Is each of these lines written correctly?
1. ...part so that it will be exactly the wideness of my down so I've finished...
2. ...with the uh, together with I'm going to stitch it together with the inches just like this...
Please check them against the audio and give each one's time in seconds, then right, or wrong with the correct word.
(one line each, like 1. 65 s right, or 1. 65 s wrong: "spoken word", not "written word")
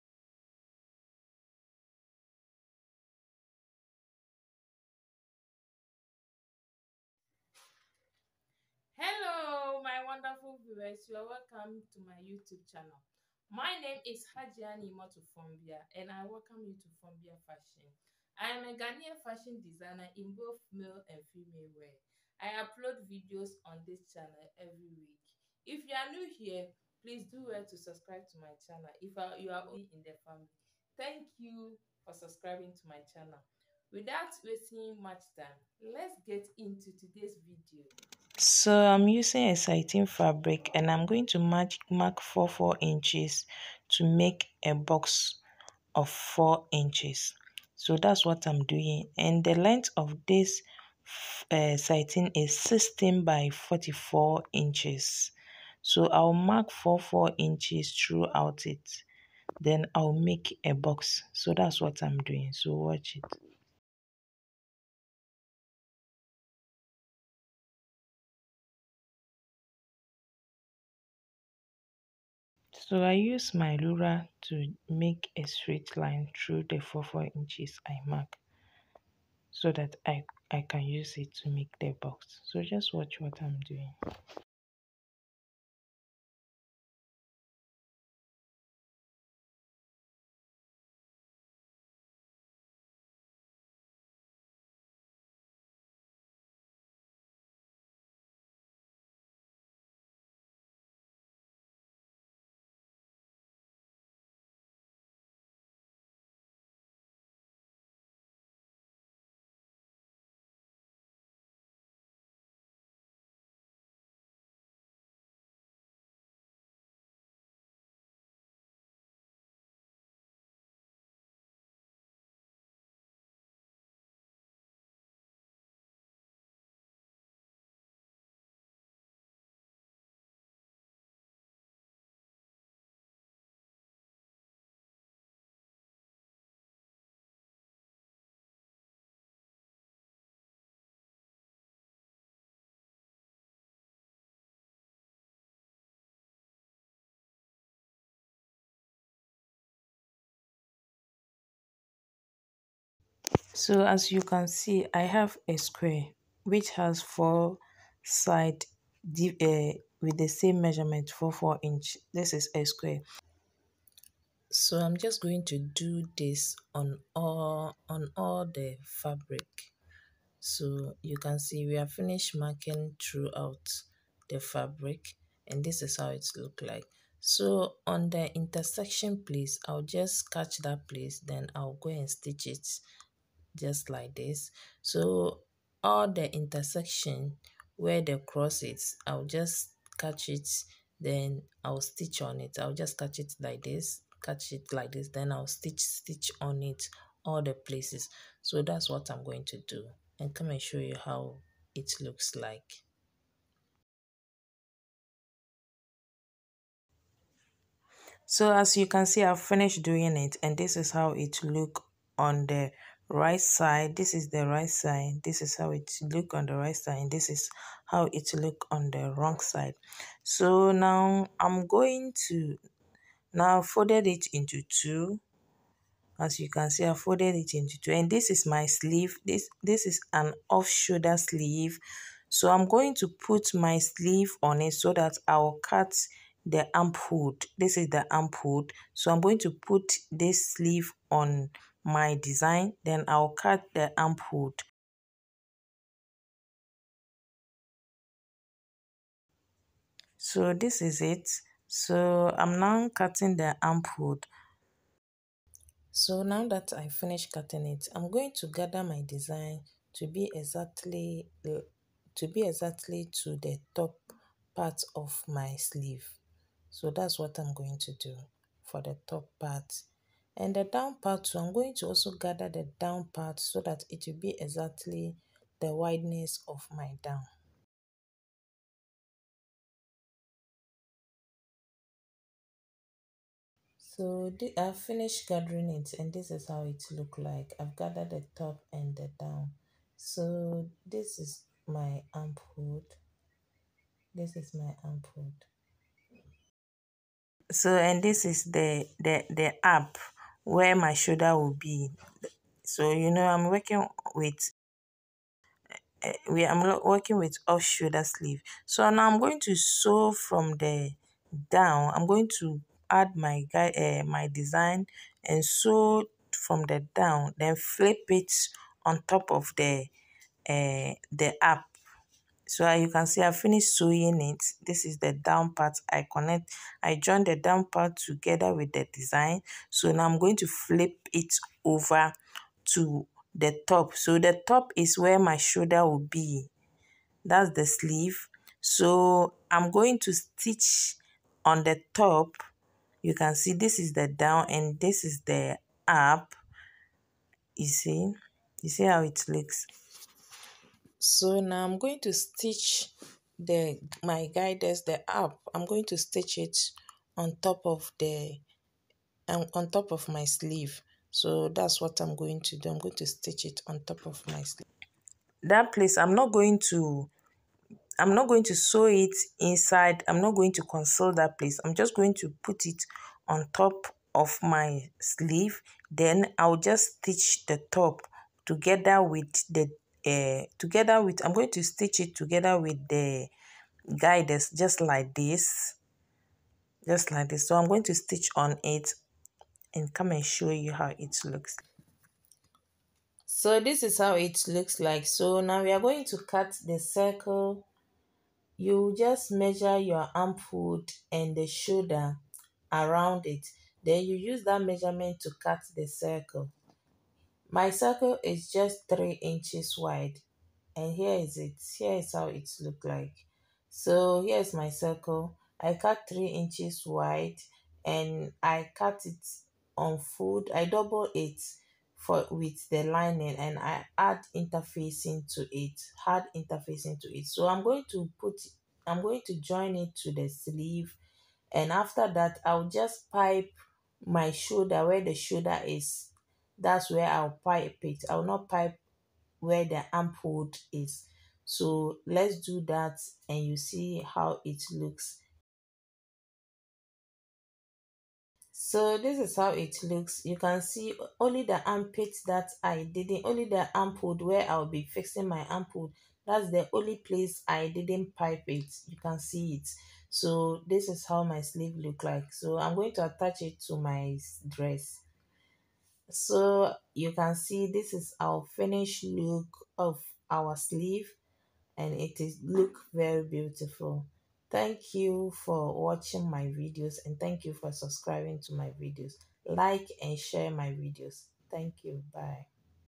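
1. 273 s right
2. 379 s wrong: "guides", not "inches".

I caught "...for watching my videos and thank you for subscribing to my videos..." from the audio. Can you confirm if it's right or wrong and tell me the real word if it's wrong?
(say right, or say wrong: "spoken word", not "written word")
right.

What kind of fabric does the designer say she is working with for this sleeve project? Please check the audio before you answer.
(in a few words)
Satin.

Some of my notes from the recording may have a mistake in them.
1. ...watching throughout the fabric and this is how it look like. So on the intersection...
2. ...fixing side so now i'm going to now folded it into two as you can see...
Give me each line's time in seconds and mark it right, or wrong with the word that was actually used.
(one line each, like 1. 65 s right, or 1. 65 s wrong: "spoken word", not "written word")
1. 172 s wrong: "marking", not "watching"
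2. 219 s wrong: "wrong", not "fixing".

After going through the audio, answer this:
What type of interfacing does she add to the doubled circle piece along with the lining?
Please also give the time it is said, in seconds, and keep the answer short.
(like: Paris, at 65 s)
Hard interfacing, at 426 s.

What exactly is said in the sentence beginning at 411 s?
Here is how it looked like.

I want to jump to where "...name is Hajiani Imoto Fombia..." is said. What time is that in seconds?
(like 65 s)
13 s.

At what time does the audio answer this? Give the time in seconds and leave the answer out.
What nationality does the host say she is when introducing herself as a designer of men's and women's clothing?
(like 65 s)
18 s.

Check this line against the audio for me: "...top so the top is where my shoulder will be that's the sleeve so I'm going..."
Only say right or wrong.
right.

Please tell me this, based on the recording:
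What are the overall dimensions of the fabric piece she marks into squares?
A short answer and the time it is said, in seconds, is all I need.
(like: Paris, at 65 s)
16 by 44 inches, at 52 s.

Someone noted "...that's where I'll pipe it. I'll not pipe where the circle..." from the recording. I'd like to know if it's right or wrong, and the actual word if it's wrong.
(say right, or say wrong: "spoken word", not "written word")
wrong: "ampoule", not "circle".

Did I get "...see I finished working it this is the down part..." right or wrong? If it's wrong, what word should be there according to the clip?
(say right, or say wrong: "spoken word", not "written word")
wrong: "sewing", not "working".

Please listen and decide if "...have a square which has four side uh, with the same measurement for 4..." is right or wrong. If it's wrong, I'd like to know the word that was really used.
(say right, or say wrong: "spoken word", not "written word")
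right.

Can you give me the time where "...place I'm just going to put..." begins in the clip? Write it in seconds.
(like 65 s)
371 s.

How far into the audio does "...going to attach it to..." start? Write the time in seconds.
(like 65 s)
462 s.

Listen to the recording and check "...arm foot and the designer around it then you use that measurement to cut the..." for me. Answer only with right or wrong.
wrong.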